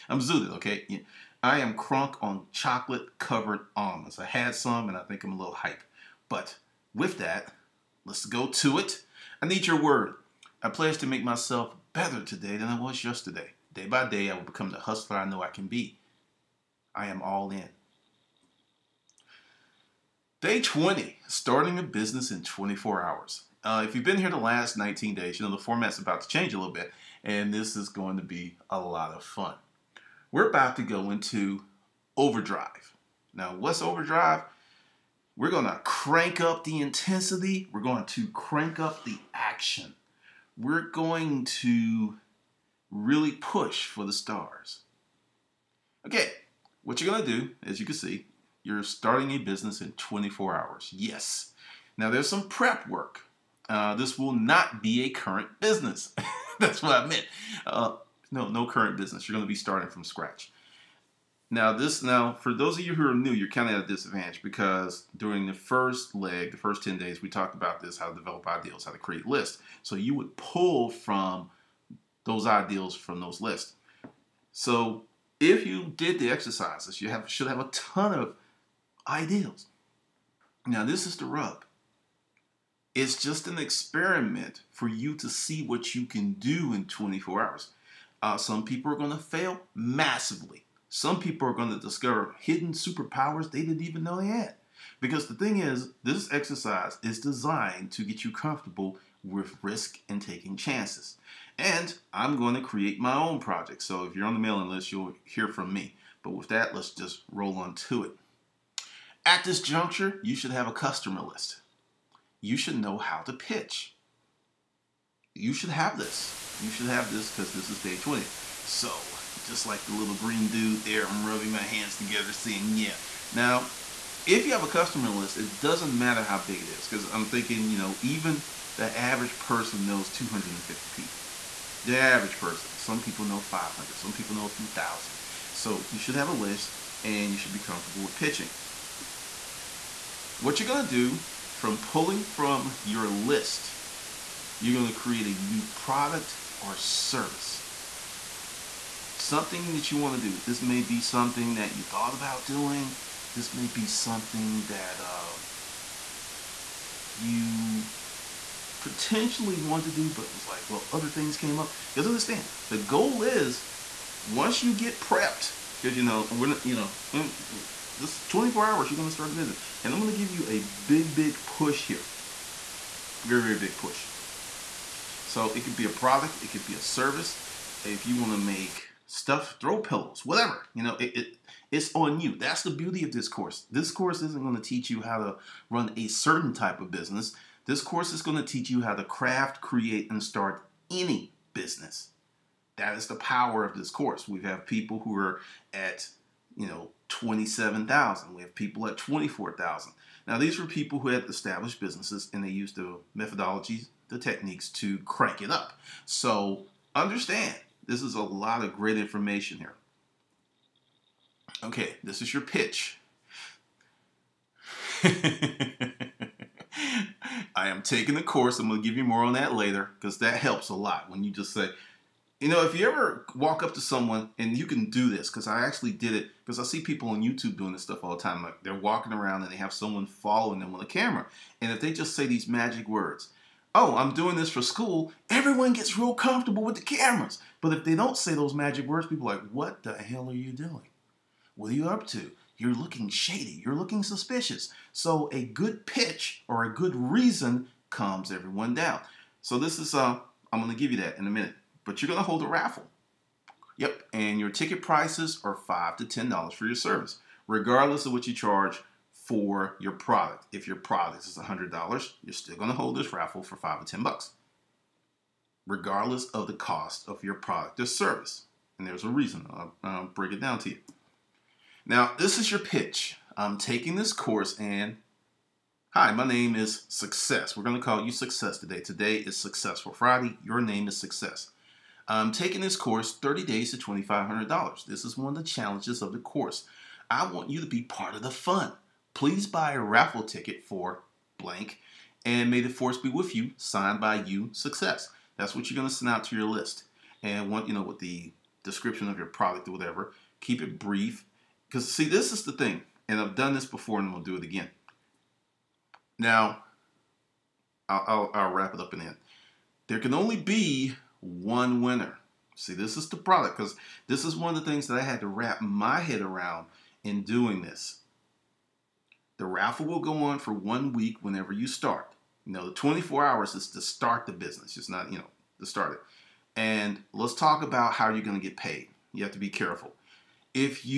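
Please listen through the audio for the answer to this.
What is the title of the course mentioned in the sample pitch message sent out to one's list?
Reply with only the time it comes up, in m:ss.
4:43.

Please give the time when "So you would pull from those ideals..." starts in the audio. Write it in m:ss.
1:09.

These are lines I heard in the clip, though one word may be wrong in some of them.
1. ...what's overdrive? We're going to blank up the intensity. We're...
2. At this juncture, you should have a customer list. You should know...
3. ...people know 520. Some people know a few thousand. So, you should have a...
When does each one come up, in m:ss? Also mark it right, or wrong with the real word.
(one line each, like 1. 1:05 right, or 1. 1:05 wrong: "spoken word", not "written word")
1. 0:33 wrong: "crank", not "blank"
2. 1:49 right
3. 2:13 wrong: "500", not "520".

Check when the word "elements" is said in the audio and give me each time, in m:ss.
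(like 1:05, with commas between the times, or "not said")
not said.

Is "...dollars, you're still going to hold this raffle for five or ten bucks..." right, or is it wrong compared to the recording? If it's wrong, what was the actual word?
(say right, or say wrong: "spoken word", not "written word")
right.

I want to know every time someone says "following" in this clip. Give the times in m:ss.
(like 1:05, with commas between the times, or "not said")
3:50.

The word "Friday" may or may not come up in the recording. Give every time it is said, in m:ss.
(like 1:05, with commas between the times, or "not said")
4:39.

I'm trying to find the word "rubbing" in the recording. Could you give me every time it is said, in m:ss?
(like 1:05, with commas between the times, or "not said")
2:01.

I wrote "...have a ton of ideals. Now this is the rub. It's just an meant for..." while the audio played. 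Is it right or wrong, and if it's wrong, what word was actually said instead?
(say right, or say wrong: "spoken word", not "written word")
wrong: "experiment", not "meant".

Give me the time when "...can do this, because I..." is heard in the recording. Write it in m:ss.
3:44.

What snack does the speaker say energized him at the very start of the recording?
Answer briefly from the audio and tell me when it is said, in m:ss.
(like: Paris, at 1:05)
chocolate covered almonds, at 0:02.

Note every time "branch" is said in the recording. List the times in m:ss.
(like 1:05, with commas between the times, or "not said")
not said.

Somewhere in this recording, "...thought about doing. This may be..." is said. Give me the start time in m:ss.
2:31.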